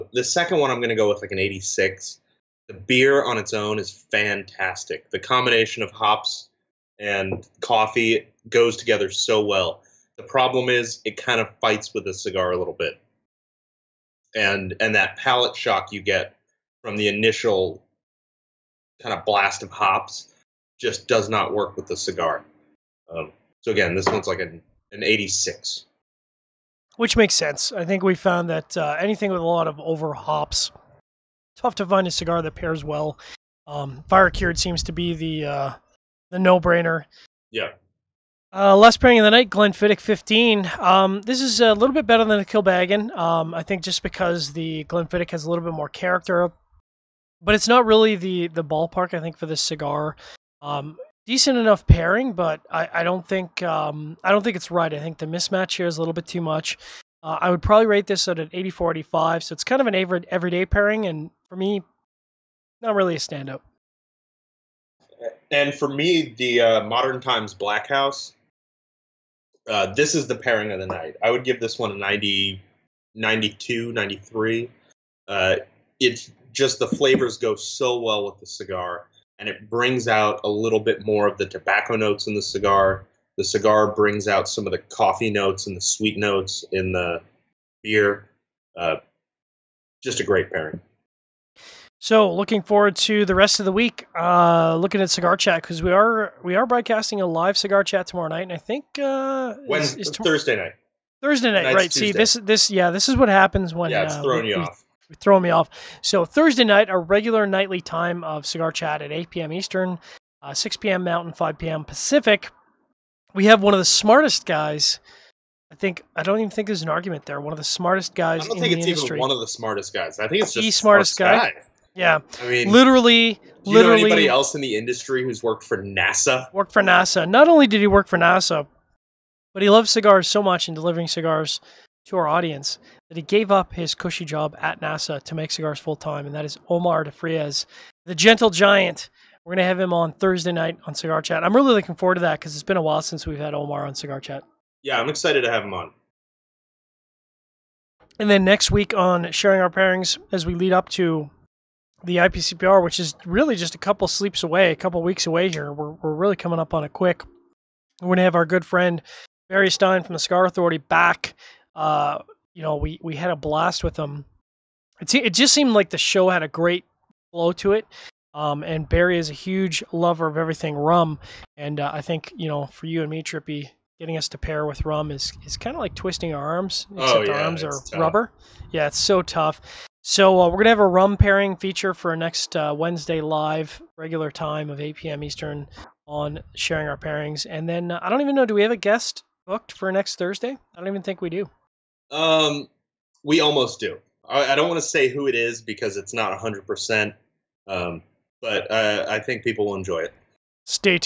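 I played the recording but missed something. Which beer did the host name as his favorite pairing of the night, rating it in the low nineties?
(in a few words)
Modern Times Black House.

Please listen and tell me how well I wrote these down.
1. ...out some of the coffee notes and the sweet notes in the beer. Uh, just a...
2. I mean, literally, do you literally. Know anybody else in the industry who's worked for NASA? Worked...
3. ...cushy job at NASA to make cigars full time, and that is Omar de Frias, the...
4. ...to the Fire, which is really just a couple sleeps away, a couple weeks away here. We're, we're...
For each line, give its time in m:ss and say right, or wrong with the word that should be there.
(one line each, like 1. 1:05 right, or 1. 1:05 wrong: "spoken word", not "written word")
1. 1:24 right
2. 2:02 right
3. 2:13 right
4. 2:30 wrong: "IPCPR", not "Fire".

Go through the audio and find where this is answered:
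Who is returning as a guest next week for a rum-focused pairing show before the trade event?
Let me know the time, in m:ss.
2:39.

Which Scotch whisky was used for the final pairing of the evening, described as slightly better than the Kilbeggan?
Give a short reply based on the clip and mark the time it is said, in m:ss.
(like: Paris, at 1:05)
Glenfiddich 15, at 0:39.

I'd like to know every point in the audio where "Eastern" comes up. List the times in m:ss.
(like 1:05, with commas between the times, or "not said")
1:49, 3:05.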